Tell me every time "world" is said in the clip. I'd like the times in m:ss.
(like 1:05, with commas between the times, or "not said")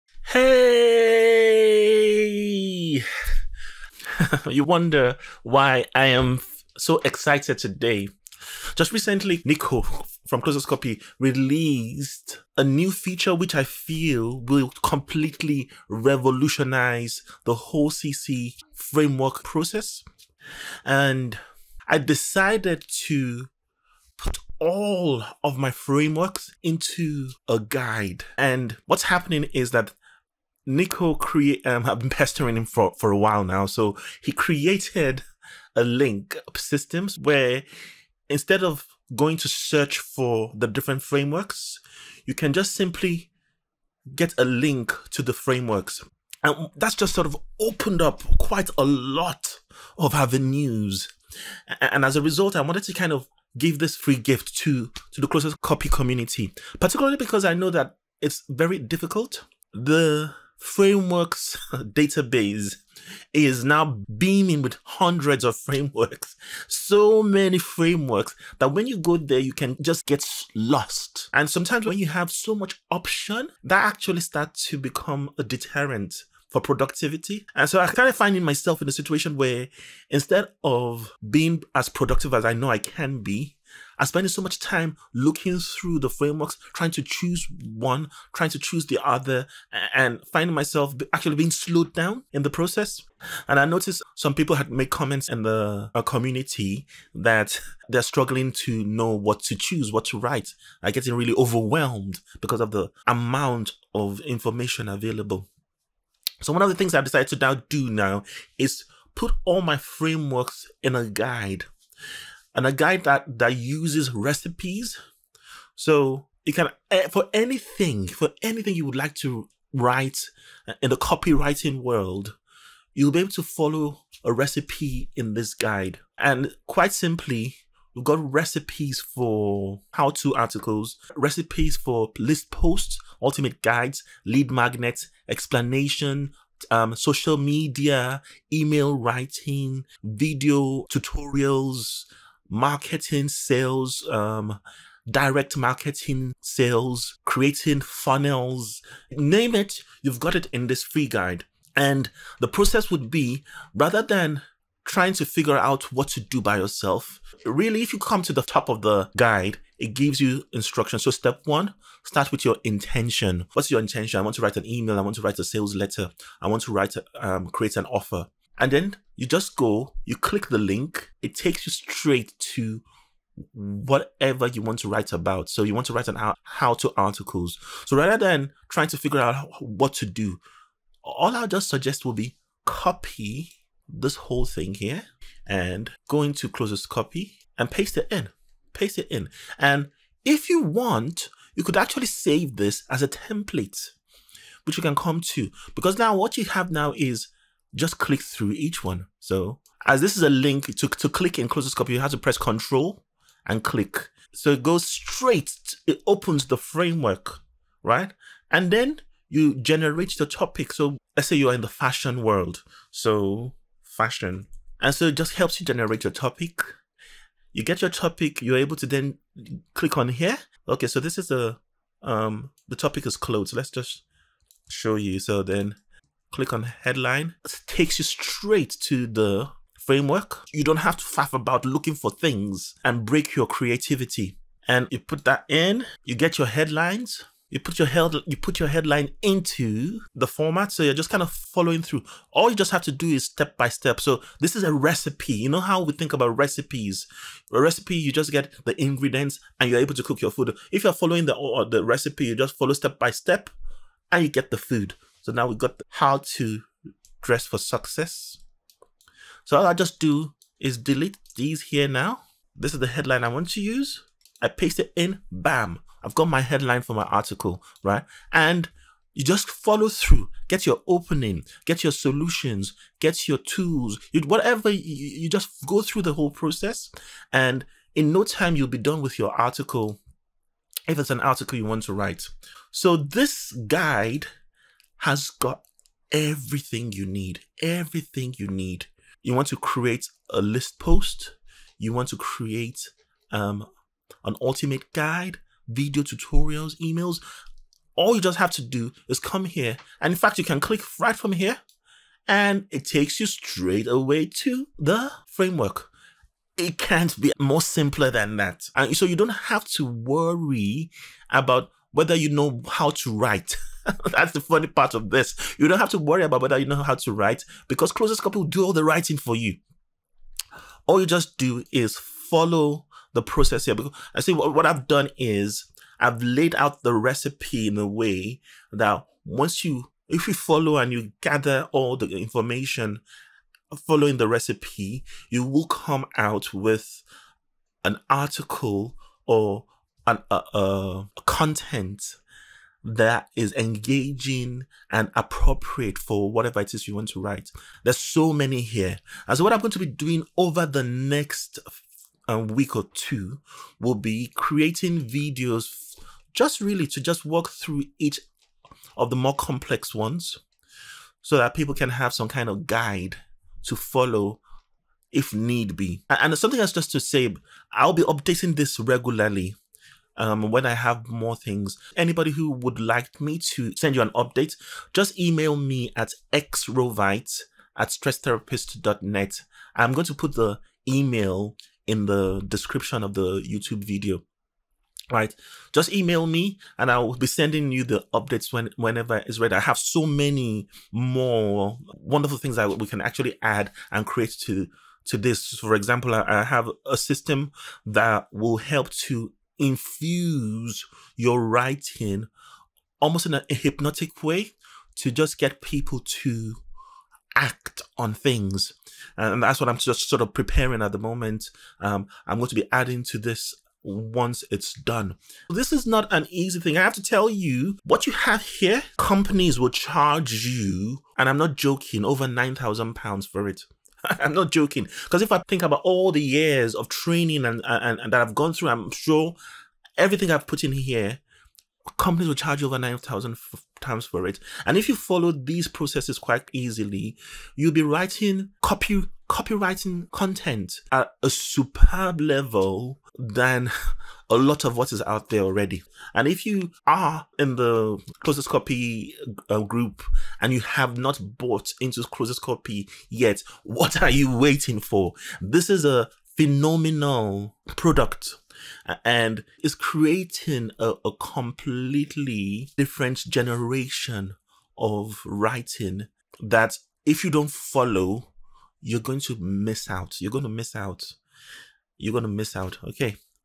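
2:01, 3:32.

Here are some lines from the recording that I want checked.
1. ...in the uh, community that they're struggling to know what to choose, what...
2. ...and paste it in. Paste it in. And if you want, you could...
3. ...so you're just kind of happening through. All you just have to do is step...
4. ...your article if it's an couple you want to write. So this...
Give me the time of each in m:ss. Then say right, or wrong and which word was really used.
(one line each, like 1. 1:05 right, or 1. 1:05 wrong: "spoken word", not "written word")
1. 1:35 right
2. 3:07 right
3. 4:00 wrong: "following", not "happening"
4. 4:39 wrong: "article", not "couple".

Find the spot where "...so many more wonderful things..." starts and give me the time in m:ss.
6:29.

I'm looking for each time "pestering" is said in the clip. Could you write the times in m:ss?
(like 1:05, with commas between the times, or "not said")
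0:32.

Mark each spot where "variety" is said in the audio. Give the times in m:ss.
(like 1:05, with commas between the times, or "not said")
not said.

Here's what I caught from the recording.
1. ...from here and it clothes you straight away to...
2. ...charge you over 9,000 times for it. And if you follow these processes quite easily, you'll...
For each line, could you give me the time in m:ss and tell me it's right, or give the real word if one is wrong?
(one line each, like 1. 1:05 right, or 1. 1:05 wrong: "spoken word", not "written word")
1. 5:01 wrong: "takes", not "clothes"
2. 7:12 right.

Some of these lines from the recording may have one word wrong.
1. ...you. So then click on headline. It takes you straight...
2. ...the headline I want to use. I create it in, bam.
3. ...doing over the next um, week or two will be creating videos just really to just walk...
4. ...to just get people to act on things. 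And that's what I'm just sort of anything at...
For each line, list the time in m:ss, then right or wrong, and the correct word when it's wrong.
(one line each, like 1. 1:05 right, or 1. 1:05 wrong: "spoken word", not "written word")
1. 3:44 right
2. 4:22 wrong: "paste", not "create"
3. 5:49 right
4. 6:44 wrong: "preparing", not "anything".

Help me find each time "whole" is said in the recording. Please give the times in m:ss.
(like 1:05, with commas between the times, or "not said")
0:17, 3:04, 4:36.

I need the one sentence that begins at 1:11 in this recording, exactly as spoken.
And sometimes when you have so much option, that actually starts to become a deterrent for productivity.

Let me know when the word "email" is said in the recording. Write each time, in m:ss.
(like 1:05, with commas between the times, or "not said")
2:18, 2:44, 4:56, 6:15, 6:20, 6:25.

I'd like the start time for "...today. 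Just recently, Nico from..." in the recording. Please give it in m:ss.
0:07.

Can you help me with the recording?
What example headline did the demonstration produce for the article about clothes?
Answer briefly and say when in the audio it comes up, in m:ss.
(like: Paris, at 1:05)
How to dress for success, at 4:15.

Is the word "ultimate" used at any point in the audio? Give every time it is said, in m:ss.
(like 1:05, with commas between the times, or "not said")
2:13, 4:54.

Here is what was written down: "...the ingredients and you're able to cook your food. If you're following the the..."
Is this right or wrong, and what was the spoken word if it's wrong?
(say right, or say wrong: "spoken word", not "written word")
right.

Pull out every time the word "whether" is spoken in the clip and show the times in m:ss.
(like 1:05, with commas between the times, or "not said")
5:11, 5:16.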